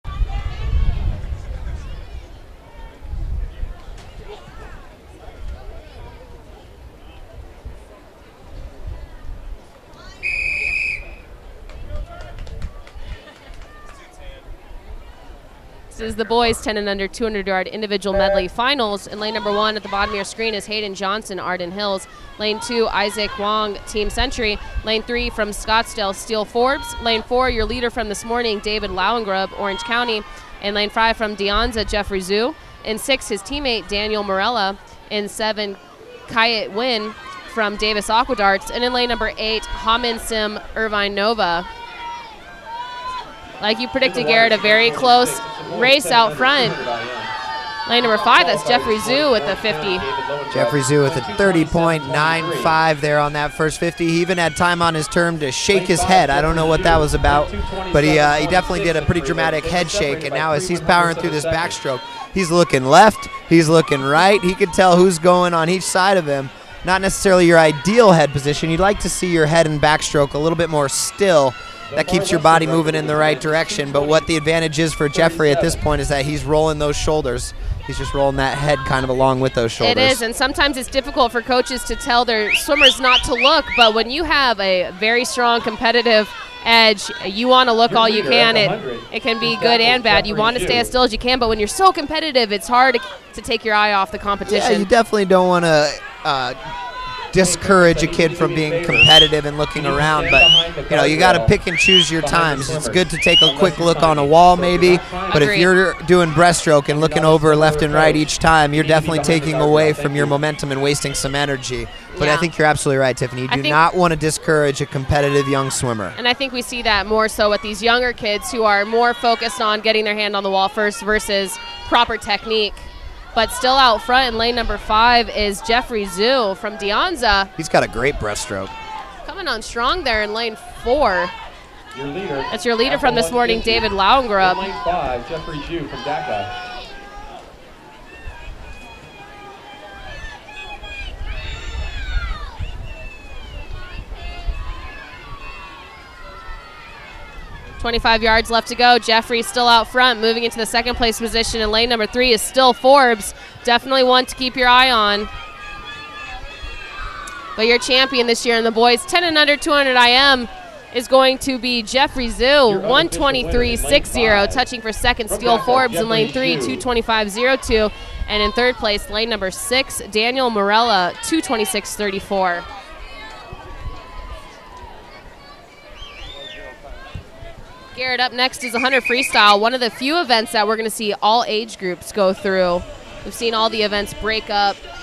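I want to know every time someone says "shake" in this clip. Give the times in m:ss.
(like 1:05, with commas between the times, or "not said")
0:55, 0:59.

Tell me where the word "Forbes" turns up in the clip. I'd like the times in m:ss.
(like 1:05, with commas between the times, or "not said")
0:26, 2:32, 2:45.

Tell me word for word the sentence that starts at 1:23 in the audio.
But when you have a very strong competitive edge.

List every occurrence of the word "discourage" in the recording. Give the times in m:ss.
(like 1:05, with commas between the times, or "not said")
1:37, 1:54.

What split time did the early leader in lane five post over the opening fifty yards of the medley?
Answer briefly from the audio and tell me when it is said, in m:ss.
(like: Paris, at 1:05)
30.95, at 0:51.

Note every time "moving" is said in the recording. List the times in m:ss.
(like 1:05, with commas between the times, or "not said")
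1:12, 2:30.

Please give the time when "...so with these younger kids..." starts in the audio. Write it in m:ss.
1:57.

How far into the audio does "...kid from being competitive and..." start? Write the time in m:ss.
1:38.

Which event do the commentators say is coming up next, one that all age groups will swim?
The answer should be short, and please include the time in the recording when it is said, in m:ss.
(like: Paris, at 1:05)
100 Freestyle, at 2:58.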